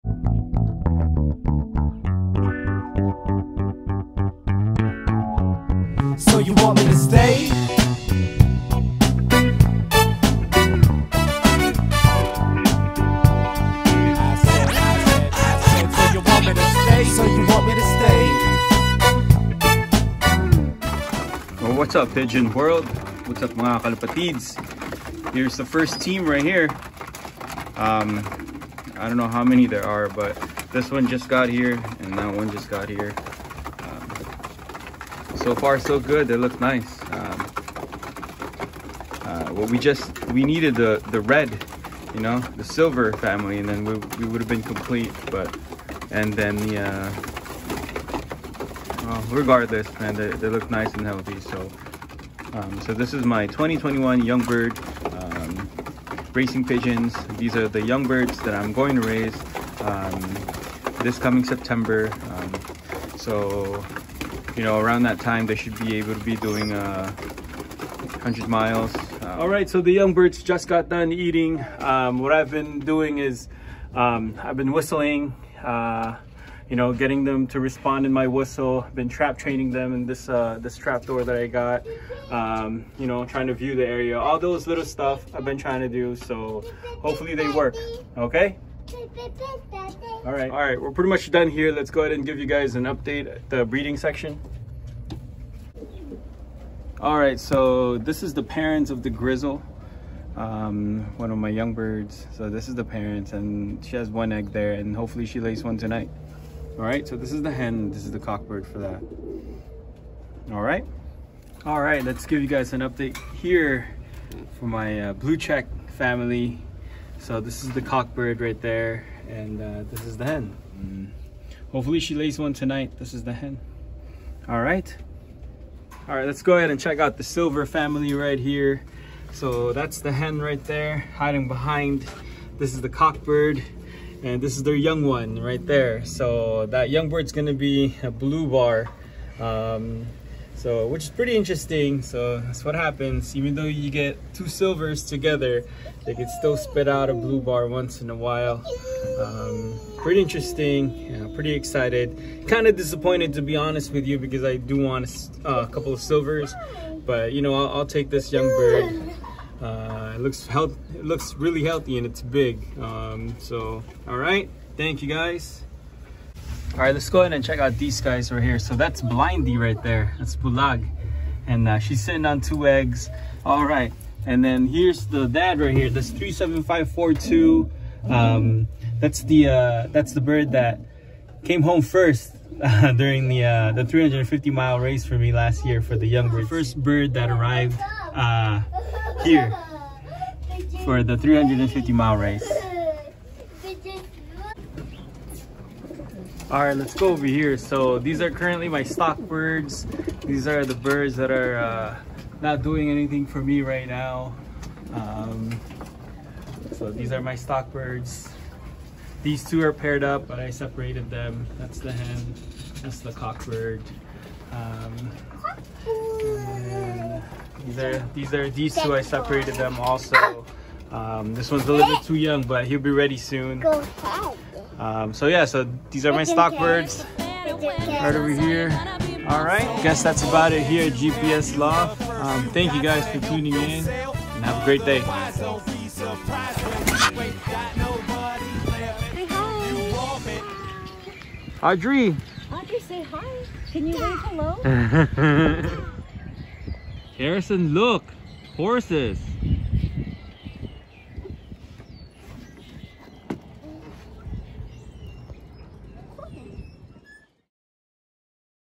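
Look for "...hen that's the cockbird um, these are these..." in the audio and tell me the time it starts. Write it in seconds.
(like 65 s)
211 s.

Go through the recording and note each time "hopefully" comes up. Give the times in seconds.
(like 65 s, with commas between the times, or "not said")
87 s, 104 s, 121 s.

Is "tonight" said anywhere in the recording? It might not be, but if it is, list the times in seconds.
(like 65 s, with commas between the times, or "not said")
105 s, 122 s.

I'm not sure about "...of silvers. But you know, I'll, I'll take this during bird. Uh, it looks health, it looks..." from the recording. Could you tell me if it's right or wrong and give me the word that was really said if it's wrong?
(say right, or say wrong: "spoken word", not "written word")
wrong: "young", not "during".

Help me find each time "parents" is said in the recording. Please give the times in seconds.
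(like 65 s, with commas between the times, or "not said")
98 s, 102 s.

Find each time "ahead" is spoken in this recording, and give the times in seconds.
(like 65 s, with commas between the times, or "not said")
92 s, 126 s, 167 s, 223 s.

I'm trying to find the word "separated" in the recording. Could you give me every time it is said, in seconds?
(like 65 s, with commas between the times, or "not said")
210 s, 219 s.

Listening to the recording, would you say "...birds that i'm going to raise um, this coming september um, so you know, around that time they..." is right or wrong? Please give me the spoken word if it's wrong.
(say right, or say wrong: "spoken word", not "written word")
right.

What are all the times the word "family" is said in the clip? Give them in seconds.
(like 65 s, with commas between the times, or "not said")
43 s, 115 s, 127 s.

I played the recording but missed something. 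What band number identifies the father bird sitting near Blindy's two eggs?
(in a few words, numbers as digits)
37542.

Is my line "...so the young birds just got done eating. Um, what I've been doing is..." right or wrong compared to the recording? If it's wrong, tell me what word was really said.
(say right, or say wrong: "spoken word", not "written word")
right.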